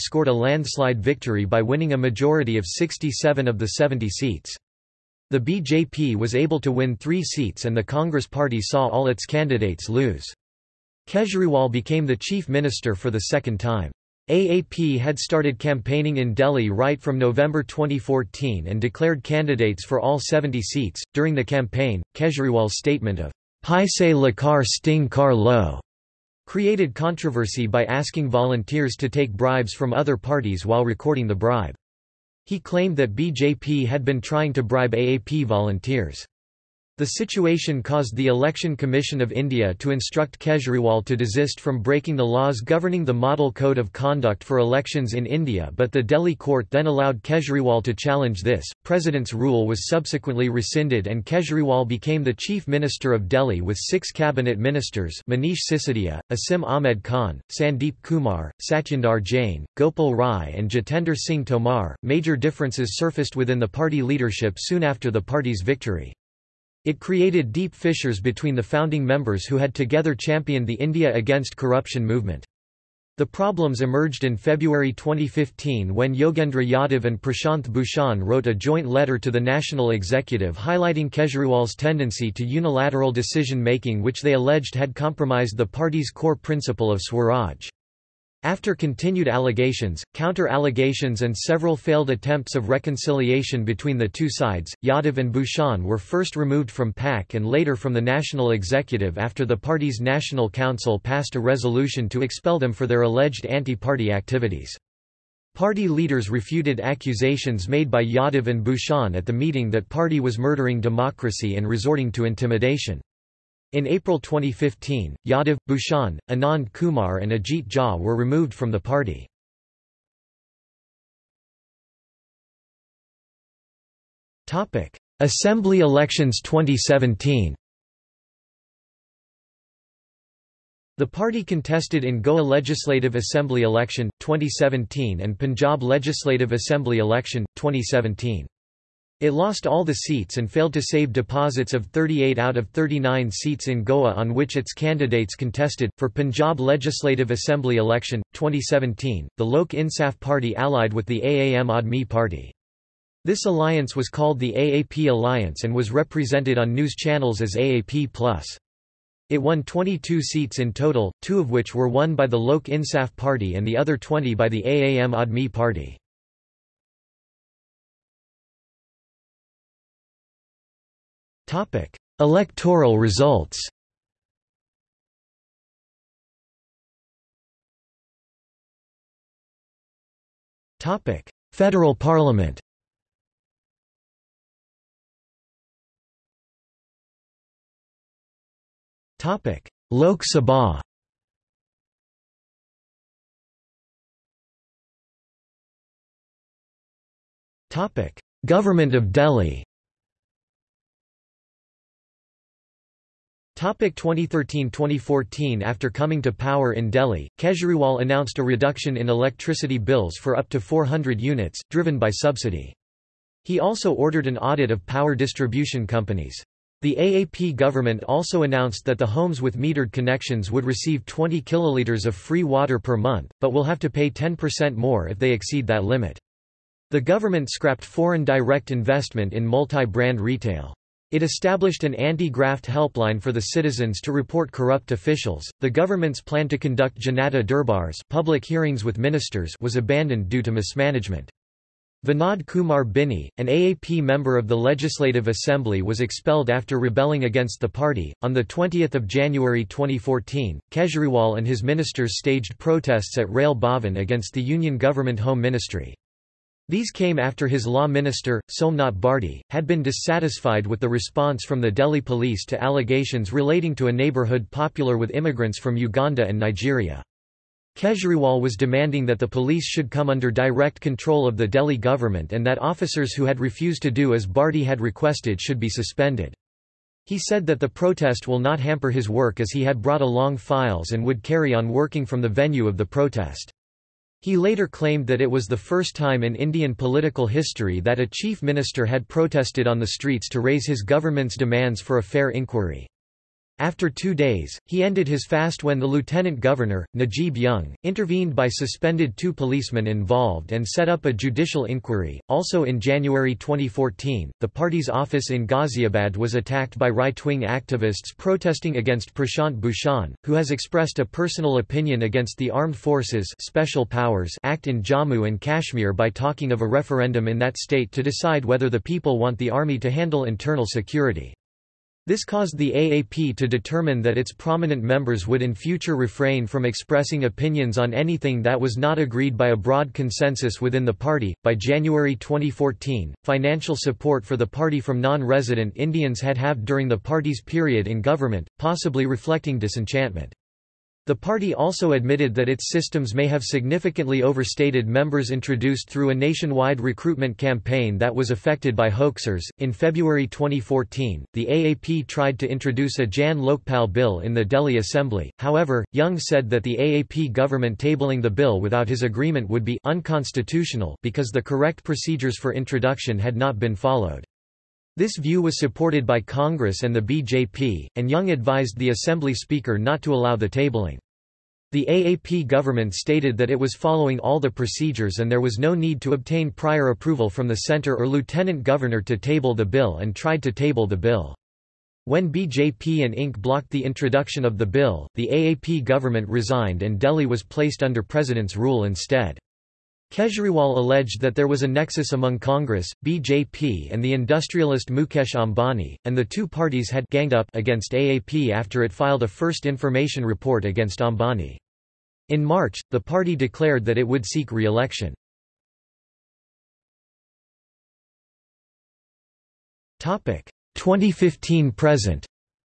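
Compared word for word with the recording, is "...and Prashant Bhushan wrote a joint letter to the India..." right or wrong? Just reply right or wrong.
wrong.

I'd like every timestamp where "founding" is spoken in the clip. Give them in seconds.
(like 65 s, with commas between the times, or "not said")
68 s.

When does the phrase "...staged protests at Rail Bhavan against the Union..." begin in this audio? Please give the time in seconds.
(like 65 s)
252 s.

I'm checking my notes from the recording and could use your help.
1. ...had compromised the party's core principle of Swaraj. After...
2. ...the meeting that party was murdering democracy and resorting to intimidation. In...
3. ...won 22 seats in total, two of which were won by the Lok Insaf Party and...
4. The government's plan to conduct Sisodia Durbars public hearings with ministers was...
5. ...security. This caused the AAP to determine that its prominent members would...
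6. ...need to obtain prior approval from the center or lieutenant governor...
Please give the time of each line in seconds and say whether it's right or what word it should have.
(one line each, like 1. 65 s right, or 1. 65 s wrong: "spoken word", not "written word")
1. 84 s right
2. 109 s right
3. 159 s right
4. 235 s wrong: "Janata", not "Sisodia"
5. 320 s right
6. 375 s right.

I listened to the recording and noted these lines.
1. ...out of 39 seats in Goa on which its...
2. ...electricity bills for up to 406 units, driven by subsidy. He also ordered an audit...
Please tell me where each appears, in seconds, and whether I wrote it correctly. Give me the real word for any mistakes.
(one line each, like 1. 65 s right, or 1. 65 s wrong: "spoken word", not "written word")
1. 142 s right
2. 209 s wrong: "400", not "406".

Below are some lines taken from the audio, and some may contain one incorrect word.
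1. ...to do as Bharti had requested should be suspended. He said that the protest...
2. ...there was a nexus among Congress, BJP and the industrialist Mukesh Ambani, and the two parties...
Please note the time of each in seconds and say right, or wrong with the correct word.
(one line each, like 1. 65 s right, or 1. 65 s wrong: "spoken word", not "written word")
1. 273 s right
2. 391 s right.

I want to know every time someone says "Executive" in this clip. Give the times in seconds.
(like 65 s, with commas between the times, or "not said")
79 s, 98 s.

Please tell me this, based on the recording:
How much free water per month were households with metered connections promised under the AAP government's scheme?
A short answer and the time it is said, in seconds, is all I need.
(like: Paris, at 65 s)
20 kiloliters, at 221 s.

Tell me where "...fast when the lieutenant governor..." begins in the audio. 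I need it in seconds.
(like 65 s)
295 s.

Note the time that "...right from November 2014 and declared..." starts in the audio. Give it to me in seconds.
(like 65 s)
16 s.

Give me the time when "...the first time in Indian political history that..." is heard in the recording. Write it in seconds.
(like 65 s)
285 s.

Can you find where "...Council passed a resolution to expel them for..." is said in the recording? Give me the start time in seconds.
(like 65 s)
100 s.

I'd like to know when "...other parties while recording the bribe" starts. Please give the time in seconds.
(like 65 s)
29 s.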